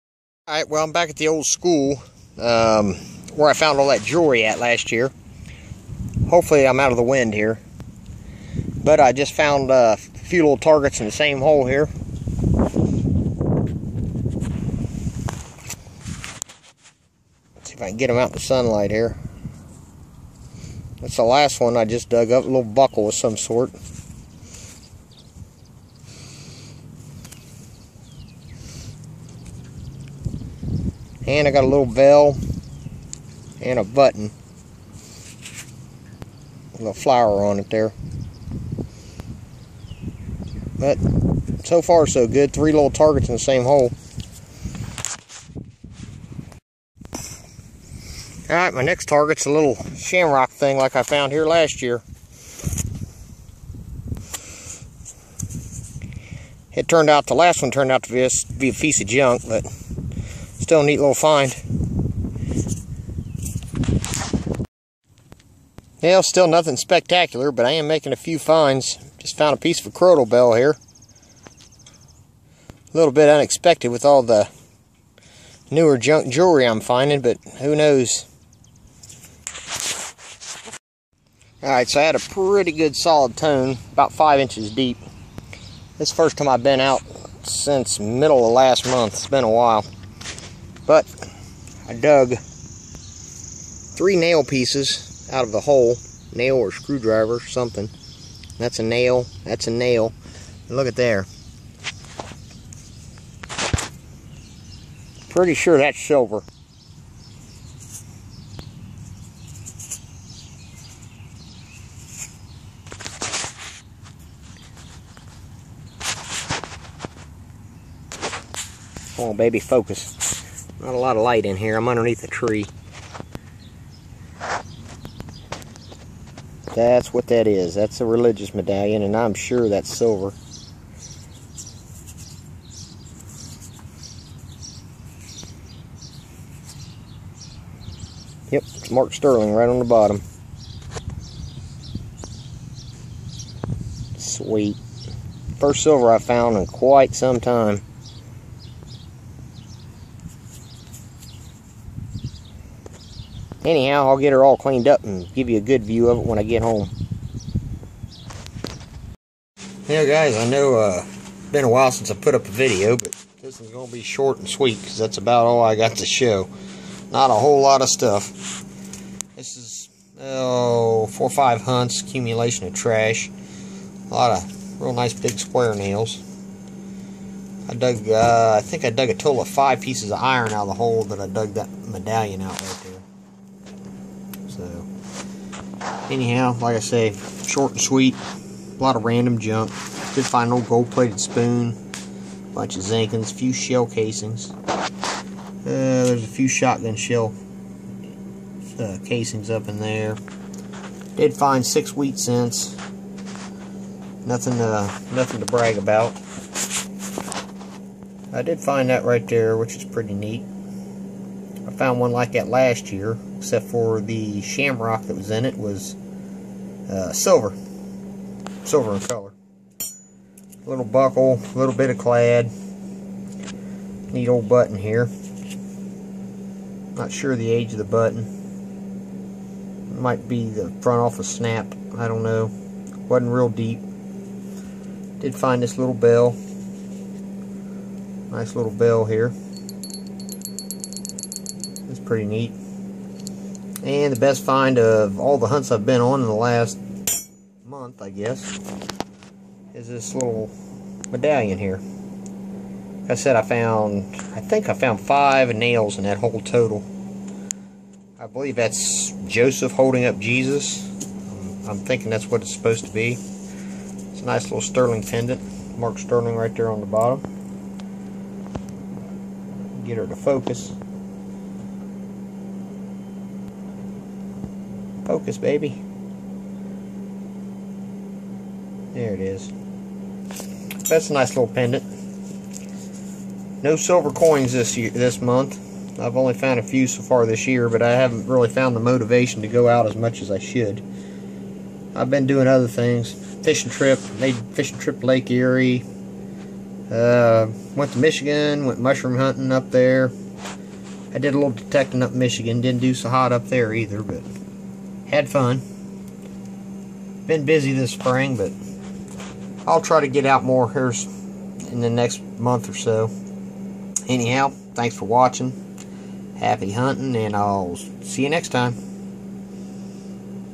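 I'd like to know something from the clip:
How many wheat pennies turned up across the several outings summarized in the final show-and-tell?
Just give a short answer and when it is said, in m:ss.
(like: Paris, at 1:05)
6, at 3:21.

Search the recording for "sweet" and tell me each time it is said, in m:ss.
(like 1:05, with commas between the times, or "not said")
2:24, 2:44, 3:07.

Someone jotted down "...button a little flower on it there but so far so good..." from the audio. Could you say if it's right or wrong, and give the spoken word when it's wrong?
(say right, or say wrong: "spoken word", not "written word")
right.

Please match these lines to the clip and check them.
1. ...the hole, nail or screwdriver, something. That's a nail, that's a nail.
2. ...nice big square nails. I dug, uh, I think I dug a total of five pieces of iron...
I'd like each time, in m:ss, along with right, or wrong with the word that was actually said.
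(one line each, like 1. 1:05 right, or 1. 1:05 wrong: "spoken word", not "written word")
1. 1:35 right
2. 2:54 right.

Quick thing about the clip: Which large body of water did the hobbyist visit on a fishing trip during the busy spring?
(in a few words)
Lake Erie.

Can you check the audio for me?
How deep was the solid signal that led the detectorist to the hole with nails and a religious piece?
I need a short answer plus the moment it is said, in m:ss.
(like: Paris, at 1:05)
5 inches, at 1:23.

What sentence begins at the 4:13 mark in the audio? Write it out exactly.
Like I said, I found, I think I found five nails in that whole total.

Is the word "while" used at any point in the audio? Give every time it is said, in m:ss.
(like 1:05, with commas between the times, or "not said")
1:29, 2:41.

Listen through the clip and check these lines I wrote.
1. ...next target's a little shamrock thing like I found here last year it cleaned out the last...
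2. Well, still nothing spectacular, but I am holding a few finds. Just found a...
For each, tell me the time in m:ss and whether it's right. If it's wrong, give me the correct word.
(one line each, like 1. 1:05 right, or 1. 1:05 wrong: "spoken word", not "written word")
1. 0:48 wrong: "turned", not "cleaned"
2. 1:06 wrong: "making", not "holding".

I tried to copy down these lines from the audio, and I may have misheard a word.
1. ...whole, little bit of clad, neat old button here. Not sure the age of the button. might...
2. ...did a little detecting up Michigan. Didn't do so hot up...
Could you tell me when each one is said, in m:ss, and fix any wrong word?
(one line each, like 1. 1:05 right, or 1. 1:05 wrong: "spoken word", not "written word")
1. 3:40 wrong: "buckle", not "whole"
2. 5:01 right.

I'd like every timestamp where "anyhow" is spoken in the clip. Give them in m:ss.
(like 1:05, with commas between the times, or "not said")
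2:33, 3:06, 5:14.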